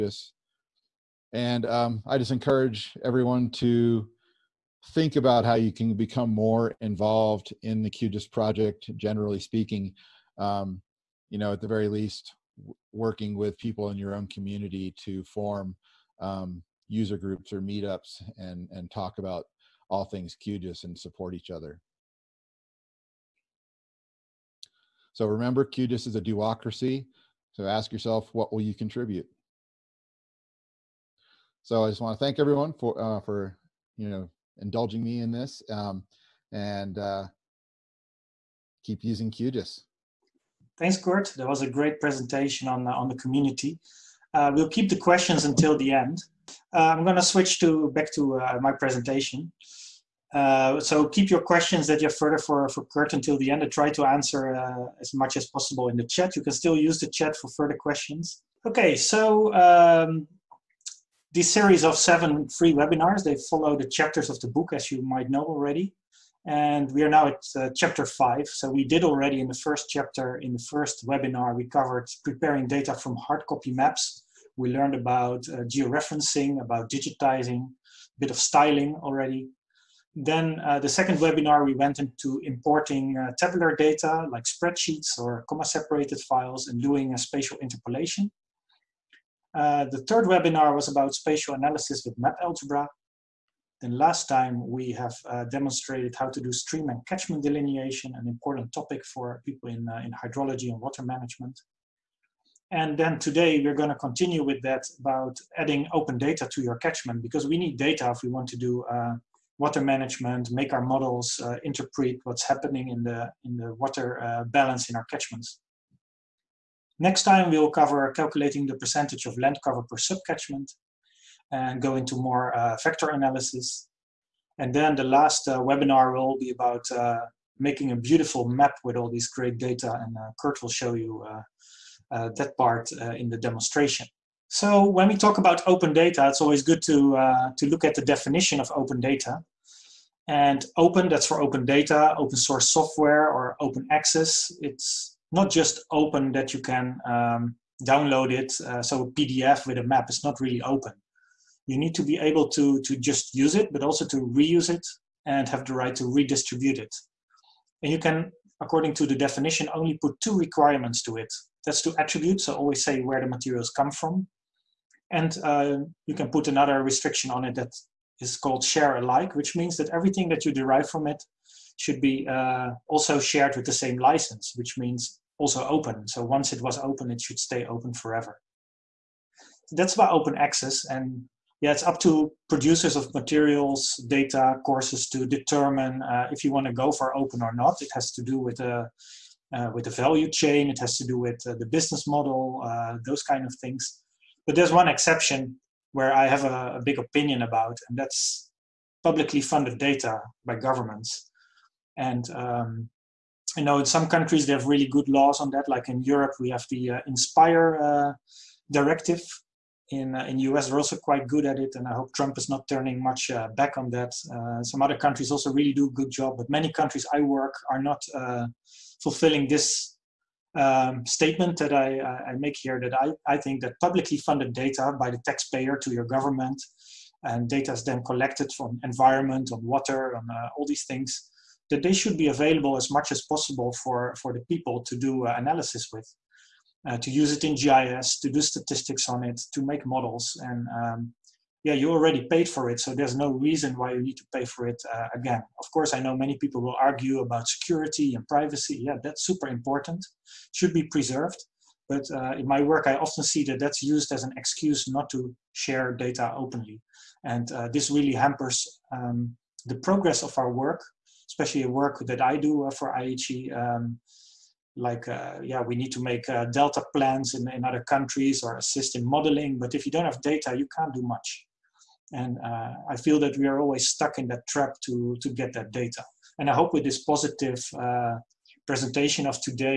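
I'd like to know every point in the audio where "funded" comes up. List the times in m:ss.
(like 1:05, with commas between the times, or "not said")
3:19, 3:44.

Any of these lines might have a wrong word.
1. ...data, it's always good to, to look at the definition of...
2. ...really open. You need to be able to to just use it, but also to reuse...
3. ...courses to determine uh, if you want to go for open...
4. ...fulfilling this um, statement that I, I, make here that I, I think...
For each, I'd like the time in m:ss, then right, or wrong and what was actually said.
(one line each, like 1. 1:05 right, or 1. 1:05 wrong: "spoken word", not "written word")
1. 2:15 right
2. 2:30 right
3. 3:04 right
4. 3:39 right.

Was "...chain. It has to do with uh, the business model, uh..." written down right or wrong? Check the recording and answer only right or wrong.
right.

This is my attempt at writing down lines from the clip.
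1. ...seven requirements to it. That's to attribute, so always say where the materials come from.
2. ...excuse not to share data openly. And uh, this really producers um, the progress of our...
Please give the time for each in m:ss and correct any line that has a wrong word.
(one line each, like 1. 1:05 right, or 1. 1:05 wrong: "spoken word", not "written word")
1. 2:40 wrong: "two", not "seven"
2. 4:14 wrong: "hampers", not "producers".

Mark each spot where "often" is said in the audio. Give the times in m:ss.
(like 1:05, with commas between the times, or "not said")
4:12.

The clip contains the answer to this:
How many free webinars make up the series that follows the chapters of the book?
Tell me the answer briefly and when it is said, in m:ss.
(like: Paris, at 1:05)
7, at 1:01.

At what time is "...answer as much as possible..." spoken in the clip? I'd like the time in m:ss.
0:54.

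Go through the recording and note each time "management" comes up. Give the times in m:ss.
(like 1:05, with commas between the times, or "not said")
1:41, 1:49.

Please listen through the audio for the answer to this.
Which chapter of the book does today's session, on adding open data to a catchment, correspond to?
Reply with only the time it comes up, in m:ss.
1:08.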